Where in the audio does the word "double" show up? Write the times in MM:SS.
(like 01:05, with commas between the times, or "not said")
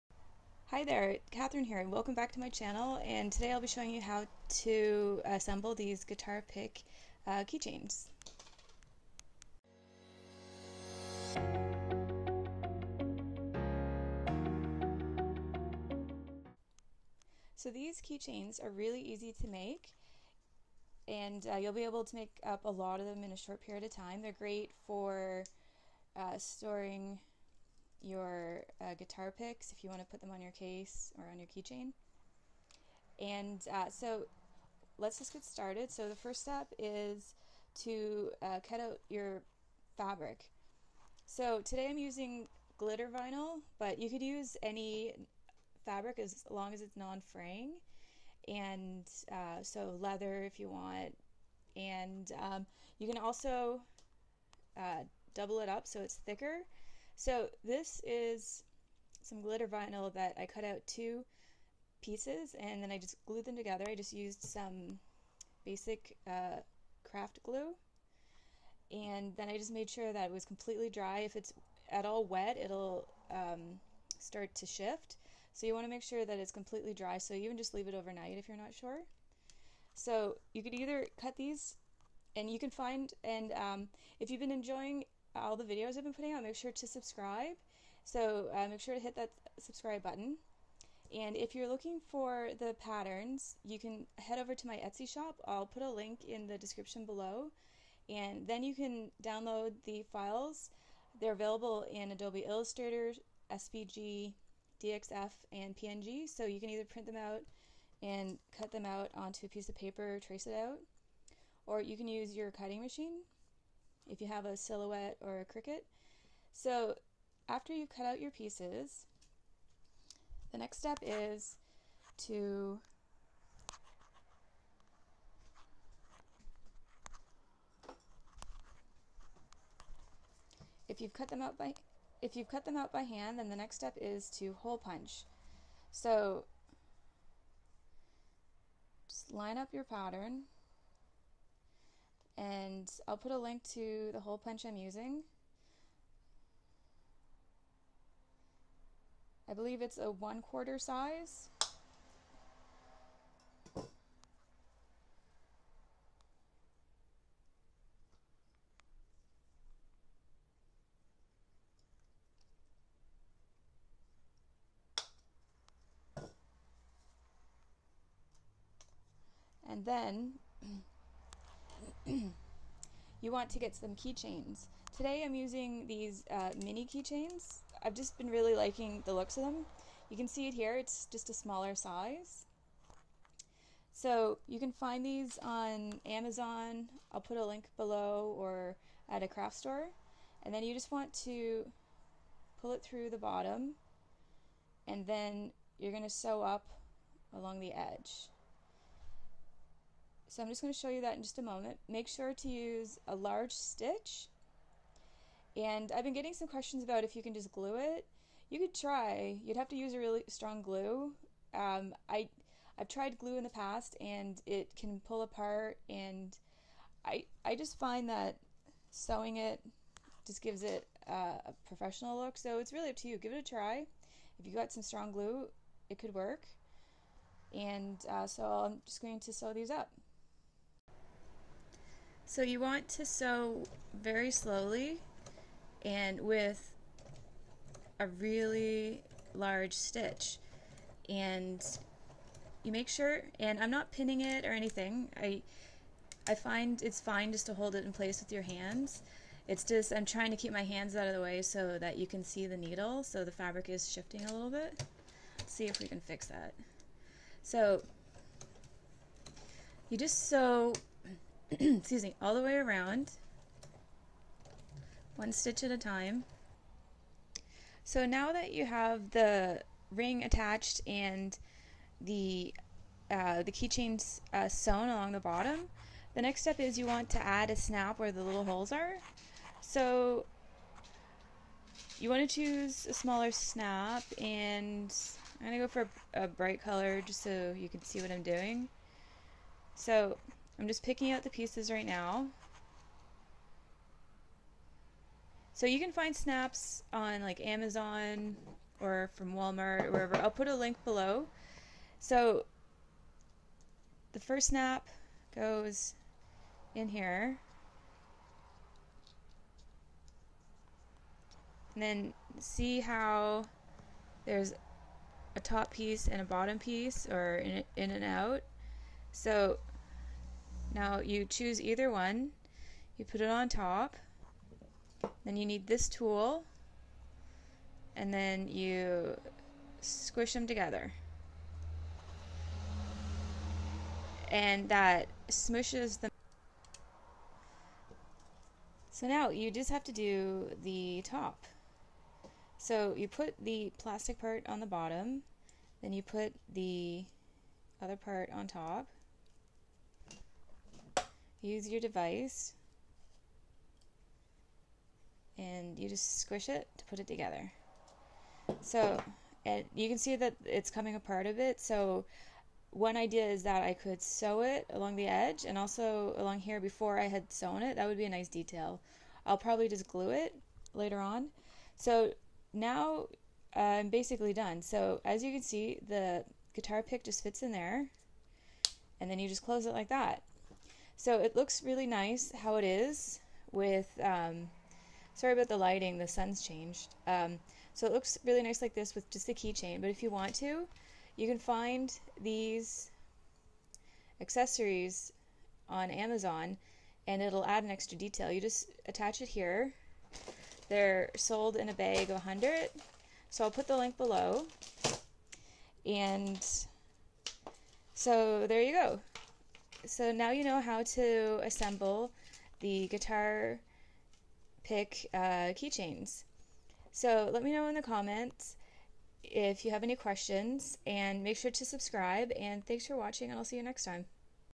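00:55.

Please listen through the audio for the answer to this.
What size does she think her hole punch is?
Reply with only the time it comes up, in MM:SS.
02:30.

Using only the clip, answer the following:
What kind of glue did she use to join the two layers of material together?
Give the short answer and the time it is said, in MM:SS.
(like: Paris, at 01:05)
Craft glue, at 01:07.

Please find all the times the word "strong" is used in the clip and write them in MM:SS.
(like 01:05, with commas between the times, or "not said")
03:30, 03:44.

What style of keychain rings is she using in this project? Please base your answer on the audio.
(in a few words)
Mini keychains.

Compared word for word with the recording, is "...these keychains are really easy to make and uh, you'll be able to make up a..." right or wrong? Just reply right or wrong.
right.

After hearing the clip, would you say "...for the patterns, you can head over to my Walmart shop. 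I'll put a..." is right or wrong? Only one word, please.
wrong.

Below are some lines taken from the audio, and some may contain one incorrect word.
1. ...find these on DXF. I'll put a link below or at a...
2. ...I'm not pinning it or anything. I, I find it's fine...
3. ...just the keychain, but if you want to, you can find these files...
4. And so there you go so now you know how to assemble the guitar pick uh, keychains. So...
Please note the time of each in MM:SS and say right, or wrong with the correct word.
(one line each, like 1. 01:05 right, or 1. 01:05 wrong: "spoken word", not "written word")
1. 03:04 wrong: "Amazon", not "DXF"
2. 04:03 right
3. 06:29 wrong: "accessories", not "files"
4. 06:45 right.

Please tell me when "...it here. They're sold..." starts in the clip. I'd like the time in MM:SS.
06:39.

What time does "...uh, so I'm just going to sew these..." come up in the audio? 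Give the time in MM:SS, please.
03:48.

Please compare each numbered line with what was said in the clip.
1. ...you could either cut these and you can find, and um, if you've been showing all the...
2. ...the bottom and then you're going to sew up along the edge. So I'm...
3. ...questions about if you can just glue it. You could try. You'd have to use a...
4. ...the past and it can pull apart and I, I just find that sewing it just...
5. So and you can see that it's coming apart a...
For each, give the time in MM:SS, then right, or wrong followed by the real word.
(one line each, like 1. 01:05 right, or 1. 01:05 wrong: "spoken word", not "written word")
1. 01:20 wrong: "enjoying", not "showing"
2. 03:13 right
3. 03:26 right
4. 03:33 right
5. 05:58 right.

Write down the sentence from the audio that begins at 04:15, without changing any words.
Let's see if we can fix that.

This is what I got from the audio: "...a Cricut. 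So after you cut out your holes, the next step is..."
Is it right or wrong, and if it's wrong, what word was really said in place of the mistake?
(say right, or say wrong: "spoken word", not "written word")
wrong: "pieces", not "holes".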